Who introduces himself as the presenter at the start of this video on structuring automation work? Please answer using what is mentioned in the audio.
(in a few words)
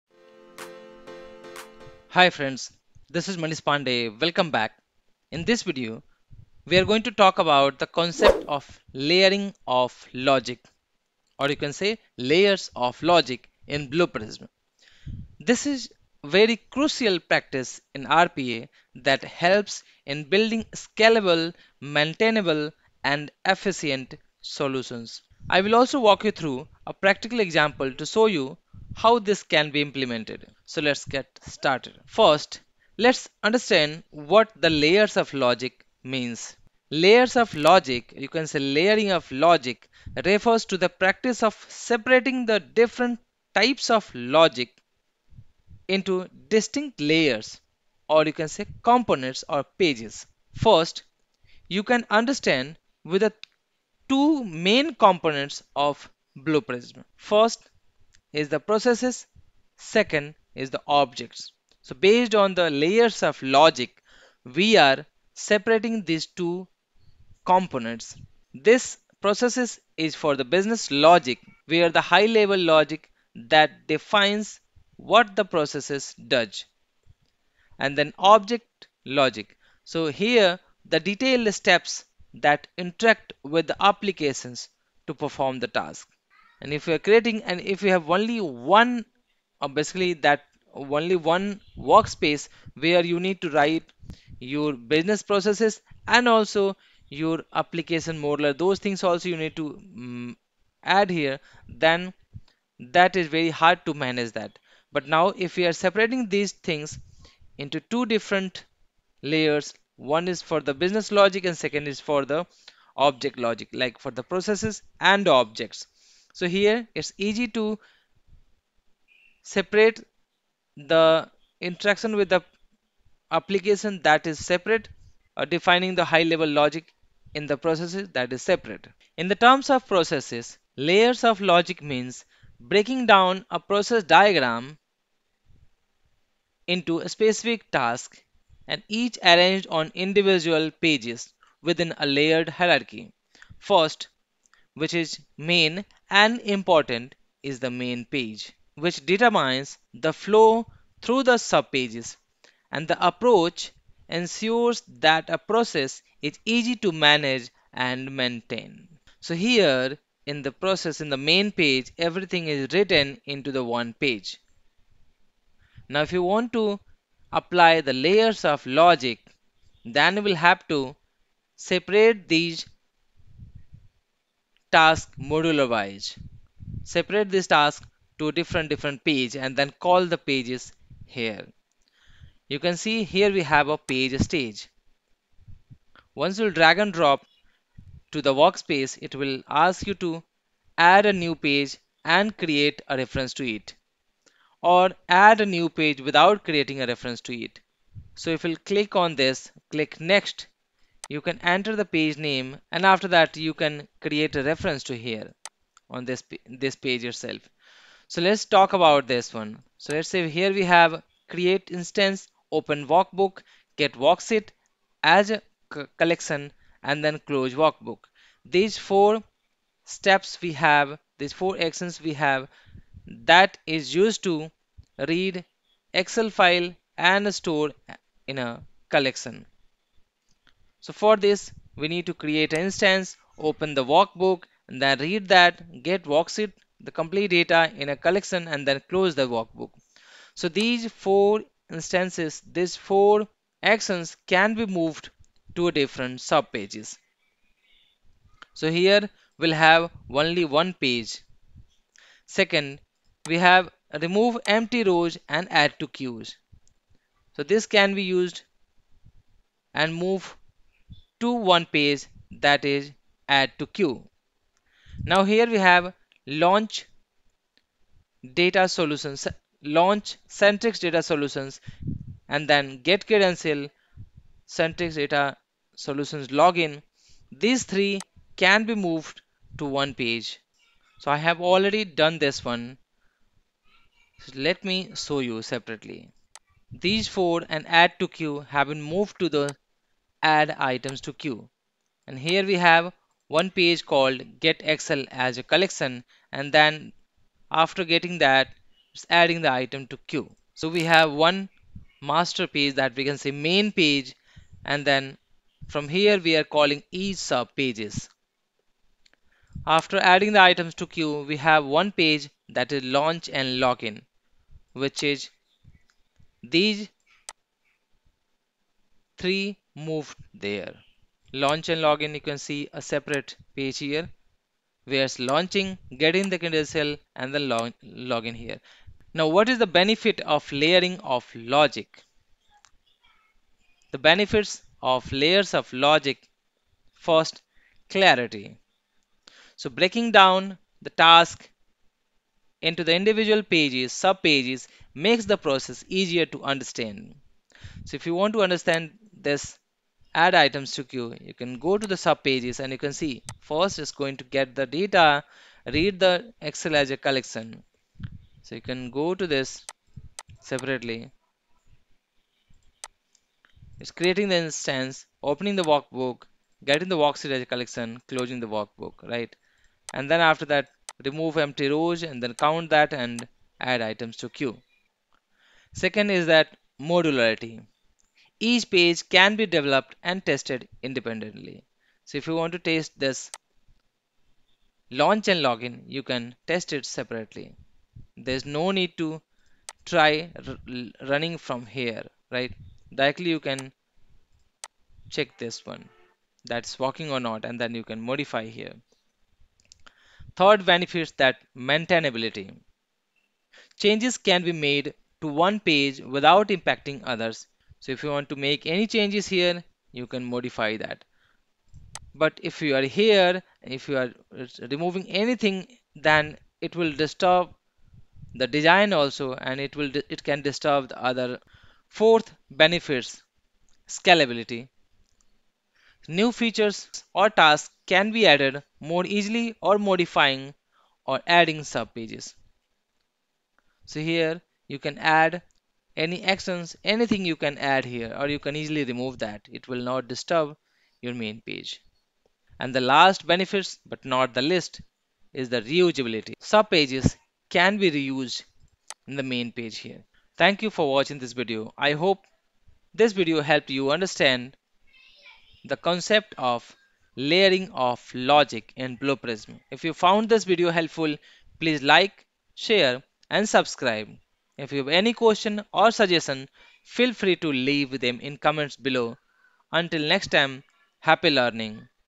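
Manish Pandey.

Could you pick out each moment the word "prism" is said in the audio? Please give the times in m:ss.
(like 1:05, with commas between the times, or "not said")
0:14, 0:56, 7:39.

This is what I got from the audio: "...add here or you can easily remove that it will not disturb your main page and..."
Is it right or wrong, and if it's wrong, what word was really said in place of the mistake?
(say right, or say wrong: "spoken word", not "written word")
right.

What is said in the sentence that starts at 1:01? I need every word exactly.
So based on the layers of logic, we are separating these two components.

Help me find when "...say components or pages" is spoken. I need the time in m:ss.
0:48.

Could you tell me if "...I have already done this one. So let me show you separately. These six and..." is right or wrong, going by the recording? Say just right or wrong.
wrong.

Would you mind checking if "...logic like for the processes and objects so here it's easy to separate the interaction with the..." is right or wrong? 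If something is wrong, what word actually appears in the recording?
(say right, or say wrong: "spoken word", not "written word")
right.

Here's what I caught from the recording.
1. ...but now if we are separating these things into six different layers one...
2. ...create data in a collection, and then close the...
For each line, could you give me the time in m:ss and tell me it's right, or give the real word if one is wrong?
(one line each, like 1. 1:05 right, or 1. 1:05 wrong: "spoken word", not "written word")
1. 1:44 wrong: "two", not "six"
2. 3:56 wrong: "complete", not "create".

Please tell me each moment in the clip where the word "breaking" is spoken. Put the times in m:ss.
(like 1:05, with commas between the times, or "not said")
2:12, 5:39.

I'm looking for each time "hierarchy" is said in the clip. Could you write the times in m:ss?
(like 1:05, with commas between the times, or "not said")
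2:22.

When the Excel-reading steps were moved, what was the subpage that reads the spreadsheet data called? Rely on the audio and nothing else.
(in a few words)
Get Excel as a collection.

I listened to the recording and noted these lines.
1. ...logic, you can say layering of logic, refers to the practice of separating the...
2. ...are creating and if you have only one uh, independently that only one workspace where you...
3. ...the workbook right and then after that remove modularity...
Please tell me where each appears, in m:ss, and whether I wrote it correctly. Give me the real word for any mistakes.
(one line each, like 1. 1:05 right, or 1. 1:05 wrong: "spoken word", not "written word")
1. 0:37 right
2. 1:26 wrong: "basically", not "independently"
3. 6:08 wrong: "empty", not "modularity".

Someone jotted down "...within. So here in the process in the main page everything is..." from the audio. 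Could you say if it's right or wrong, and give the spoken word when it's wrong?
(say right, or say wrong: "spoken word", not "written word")
wrong: "maintain", not "within".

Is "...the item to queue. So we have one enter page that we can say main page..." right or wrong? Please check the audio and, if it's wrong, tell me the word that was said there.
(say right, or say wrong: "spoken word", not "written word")
wrong: "master", not "enter".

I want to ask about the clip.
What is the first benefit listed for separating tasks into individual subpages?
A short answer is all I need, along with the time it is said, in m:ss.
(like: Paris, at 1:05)
Clarity, at 5:37.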